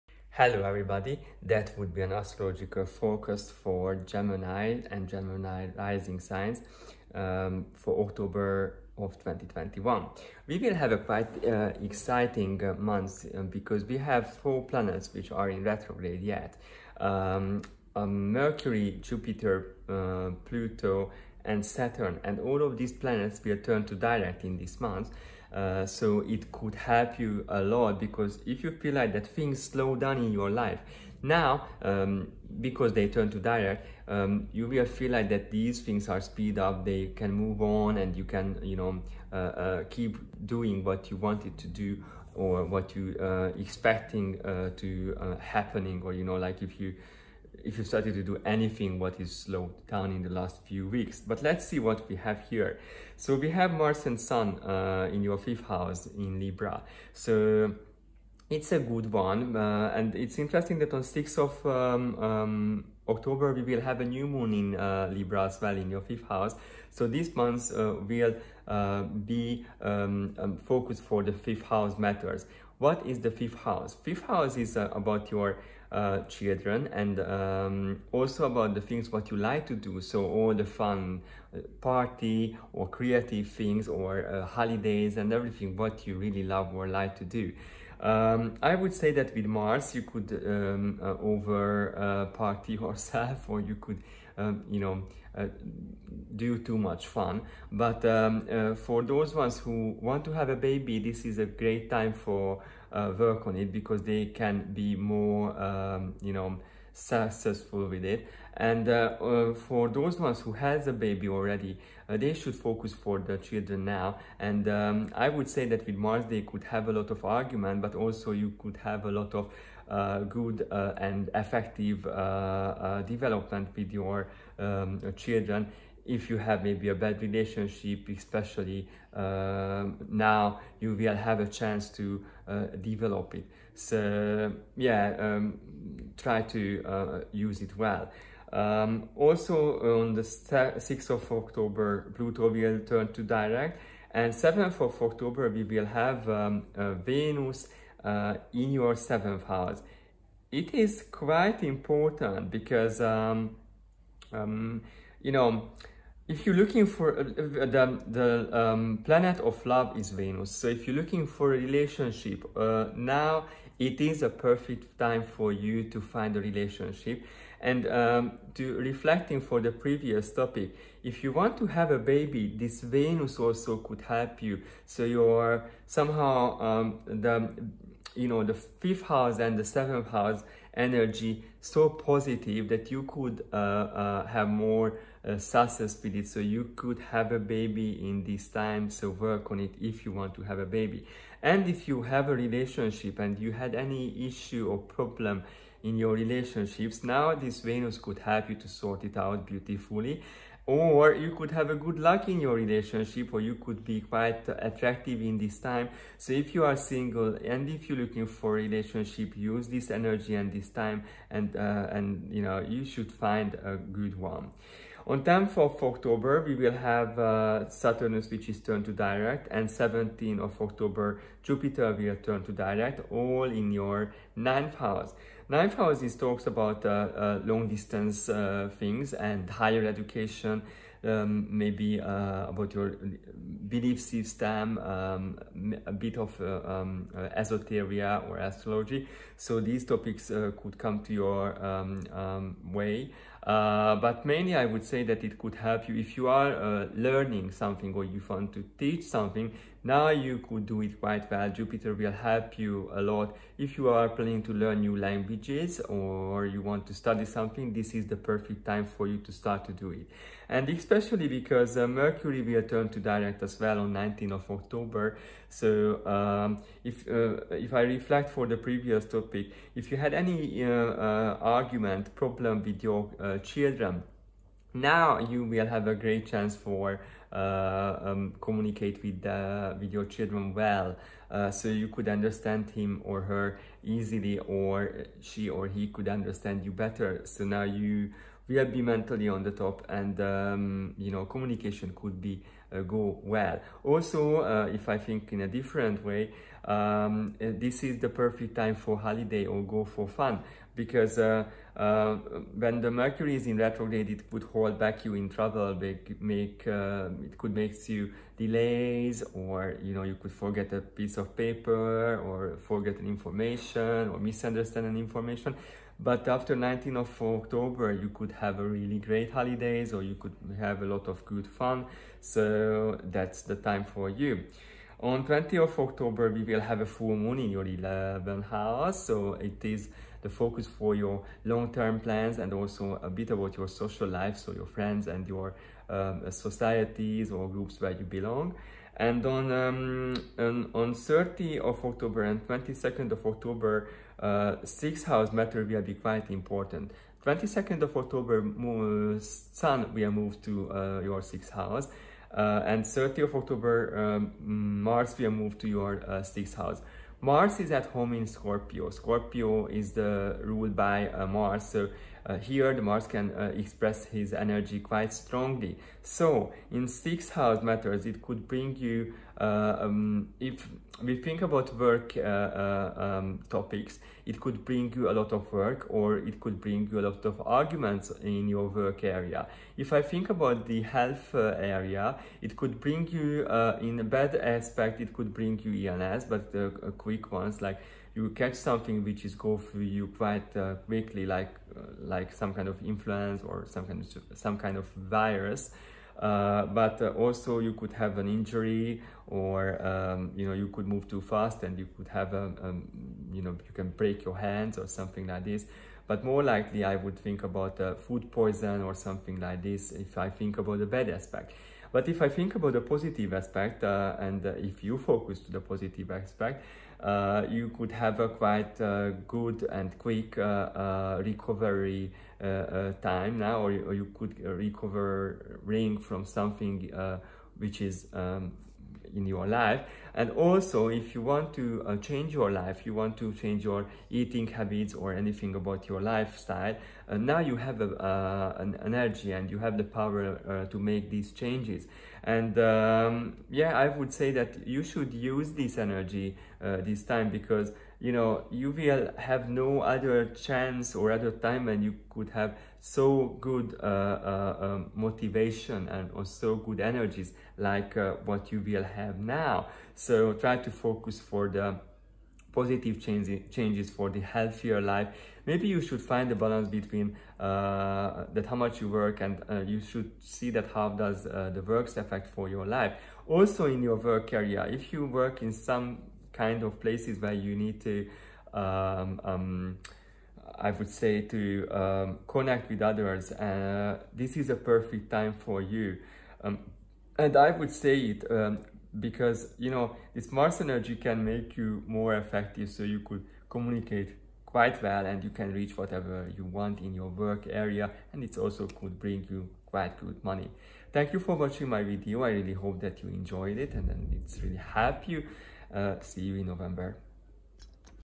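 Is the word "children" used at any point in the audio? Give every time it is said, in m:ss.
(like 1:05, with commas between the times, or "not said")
1:16, 1:53, 2:05, 4:33, 4:40.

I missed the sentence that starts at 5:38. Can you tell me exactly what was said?
And on, um, on, on 30 of October and 22nd of October, uh, sixth house matter will be quite important.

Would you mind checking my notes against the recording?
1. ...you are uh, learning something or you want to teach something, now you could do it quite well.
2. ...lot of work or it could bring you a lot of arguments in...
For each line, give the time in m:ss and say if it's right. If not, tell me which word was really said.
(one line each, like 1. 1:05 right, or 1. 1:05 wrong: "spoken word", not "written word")
1. 4:06 right
2. 6:15 right.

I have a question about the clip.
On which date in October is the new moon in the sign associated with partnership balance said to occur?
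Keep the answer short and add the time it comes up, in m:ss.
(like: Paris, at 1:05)
6th of October, at 1:01.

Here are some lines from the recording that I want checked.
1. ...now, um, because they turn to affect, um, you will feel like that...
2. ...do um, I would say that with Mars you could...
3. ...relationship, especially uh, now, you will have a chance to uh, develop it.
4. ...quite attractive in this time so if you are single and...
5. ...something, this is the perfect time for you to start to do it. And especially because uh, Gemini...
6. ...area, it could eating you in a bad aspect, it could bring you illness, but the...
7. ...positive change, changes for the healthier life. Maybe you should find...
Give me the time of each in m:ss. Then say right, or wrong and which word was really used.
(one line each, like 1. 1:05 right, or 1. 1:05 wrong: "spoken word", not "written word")
1. 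0:31 wrong: "direct", not "affect"
2. 1:27 right
3. 2:07 right
4. 3:24 right
5. 4:17 wrong: "Mercury", not "Gemini"
6. 6:21 wrong: "bring", not "eating"
7. 7:42 right.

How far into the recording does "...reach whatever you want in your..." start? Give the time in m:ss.
8:15.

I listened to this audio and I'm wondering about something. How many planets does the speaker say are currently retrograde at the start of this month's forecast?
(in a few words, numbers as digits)
4.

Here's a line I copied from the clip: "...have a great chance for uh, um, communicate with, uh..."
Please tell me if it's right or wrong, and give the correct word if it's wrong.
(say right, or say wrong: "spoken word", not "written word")
right.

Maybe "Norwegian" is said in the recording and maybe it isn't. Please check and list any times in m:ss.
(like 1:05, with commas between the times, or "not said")
not said.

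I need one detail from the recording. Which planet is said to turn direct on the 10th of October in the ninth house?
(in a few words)
Saturn.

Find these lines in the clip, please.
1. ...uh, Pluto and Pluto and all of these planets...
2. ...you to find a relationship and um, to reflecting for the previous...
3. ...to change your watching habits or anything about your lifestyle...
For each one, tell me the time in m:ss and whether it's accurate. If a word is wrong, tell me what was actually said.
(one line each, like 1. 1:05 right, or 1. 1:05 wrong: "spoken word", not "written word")
1. 0:19 wrong: "Saturn", not "Pluto"
2. 2:45 right
3. 7:13 wrong: "eating", not "watching".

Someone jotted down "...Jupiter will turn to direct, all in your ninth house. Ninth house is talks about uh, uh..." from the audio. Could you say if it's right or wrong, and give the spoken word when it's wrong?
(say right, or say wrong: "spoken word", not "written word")
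right.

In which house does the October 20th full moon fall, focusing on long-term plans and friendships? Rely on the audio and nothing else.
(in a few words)
11th house.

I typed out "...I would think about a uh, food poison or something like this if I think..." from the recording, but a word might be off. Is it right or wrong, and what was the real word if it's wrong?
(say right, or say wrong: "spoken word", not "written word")
right.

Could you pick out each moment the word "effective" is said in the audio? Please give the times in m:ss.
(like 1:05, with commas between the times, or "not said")
2:01, 8:12.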